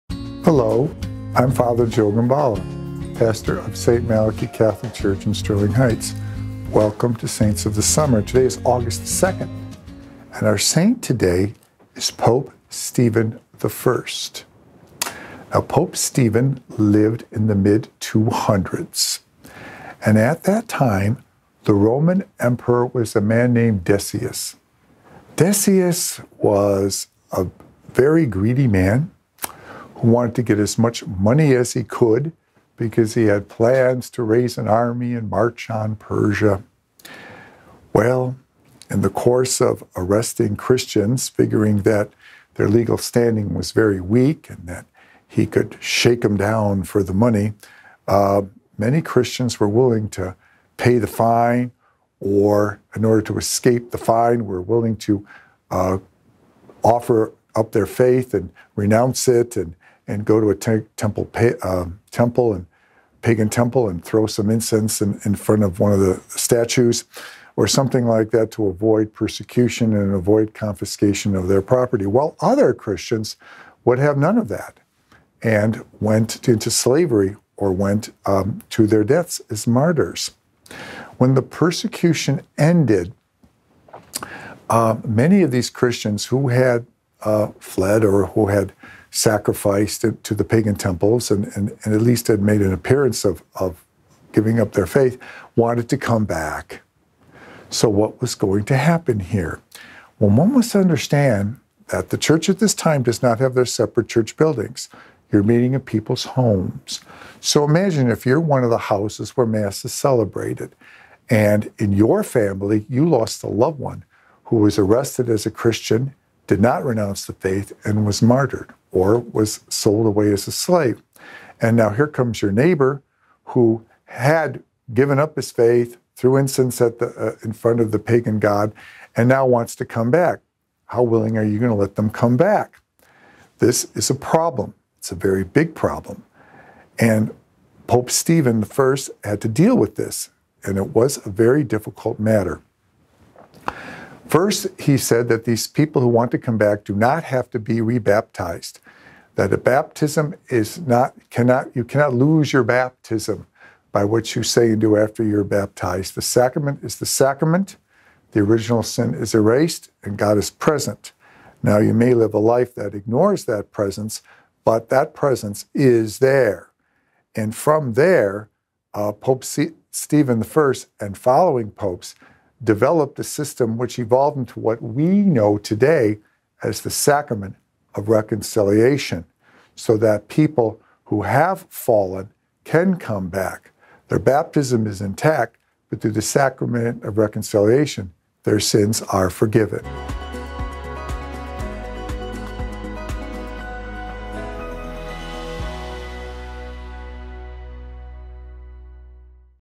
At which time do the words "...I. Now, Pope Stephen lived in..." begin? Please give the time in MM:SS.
00:13.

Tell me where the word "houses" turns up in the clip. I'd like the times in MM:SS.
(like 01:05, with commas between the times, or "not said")
01:48.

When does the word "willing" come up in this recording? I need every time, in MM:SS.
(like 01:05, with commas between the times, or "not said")
00:49, 00:54, 02:11.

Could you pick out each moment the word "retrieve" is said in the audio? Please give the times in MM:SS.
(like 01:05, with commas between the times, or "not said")
not said.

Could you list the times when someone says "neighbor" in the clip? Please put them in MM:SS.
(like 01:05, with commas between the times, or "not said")
02:02.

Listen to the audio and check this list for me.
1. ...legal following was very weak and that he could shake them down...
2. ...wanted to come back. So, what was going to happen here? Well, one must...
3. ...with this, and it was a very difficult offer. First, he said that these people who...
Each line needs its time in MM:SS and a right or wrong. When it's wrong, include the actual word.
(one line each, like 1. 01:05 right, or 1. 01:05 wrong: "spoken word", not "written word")
1. 00:42 wrong: "standing", not "following"
2. 01:35 right
3. 02:19 wrong: "matter", not "offer".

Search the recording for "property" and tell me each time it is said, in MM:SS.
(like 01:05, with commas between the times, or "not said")
01:11.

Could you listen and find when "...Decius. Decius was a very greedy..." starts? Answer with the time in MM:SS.
00:23.